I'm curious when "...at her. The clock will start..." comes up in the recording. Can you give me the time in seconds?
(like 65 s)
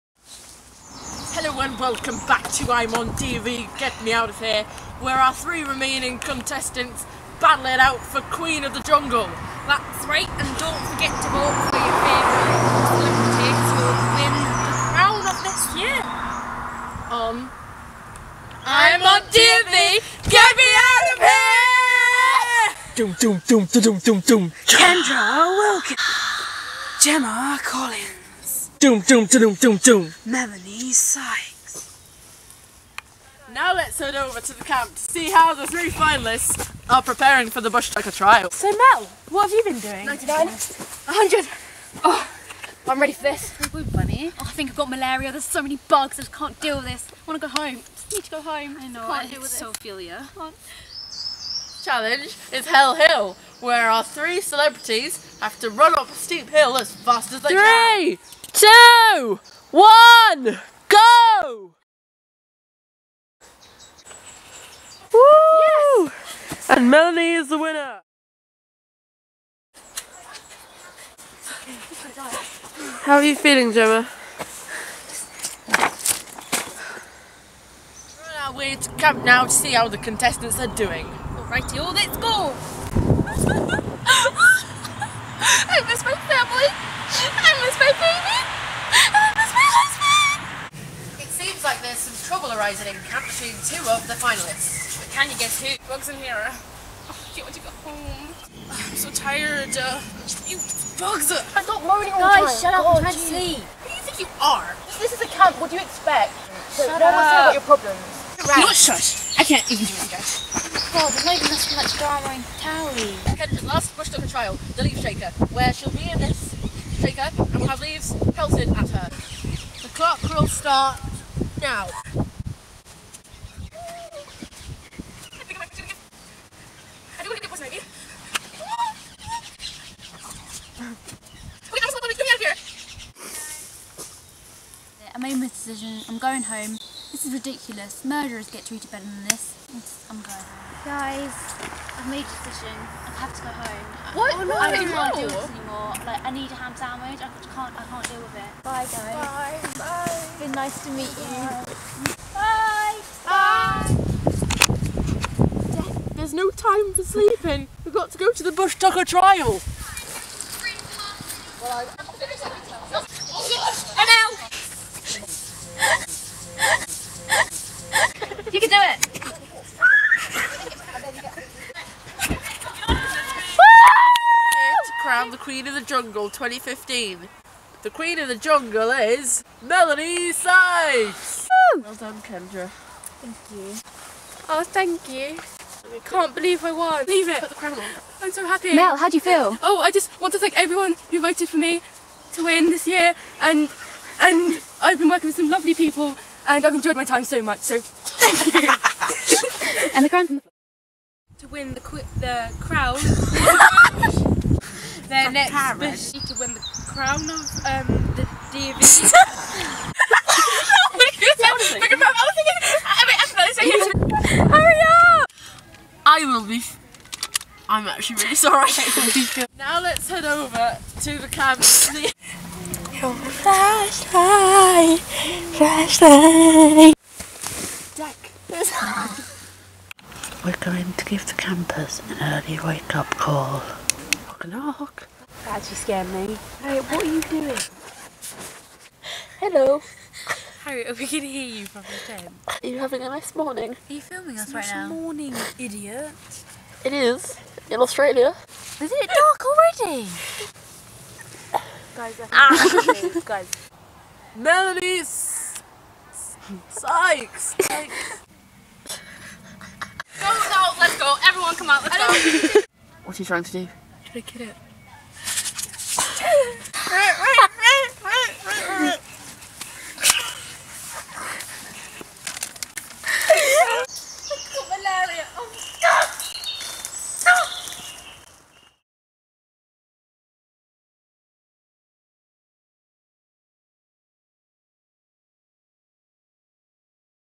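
118 s.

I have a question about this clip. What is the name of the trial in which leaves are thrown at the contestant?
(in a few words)
The Leaf Shaker.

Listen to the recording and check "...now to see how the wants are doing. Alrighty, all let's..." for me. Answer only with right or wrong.
wrong.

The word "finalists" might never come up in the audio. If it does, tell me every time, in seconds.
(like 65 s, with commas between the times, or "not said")
35 s, 94 s.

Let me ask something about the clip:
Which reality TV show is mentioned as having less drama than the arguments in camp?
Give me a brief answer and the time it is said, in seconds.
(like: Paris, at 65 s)
Towie, at 112 s.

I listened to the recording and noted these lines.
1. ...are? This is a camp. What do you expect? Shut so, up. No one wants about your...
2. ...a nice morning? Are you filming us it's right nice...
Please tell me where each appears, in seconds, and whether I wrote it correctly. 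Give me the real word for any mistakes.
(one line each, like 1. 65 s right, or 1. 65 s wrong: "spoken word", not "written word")
1. 104 s right
2. 243 s right.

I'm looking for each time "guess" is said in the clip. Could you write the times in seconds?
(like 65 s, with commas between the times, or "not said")
95 s.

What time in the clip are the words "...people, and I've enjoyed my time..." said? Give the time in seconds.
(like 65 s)
195 s.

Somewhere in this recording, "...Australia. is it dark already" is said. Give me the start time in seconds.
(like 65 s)
247 s.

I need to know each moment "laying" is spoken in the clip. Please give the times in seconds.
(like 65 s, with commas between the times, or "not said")
not said.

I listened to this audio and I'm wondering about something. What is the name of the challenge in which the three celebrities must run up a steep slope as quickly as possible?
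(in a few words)
Hell Hill.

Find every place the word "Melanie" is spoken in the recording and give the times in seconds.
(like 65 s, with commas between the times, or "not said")
30 s, 66 s, 179 s, 254 s.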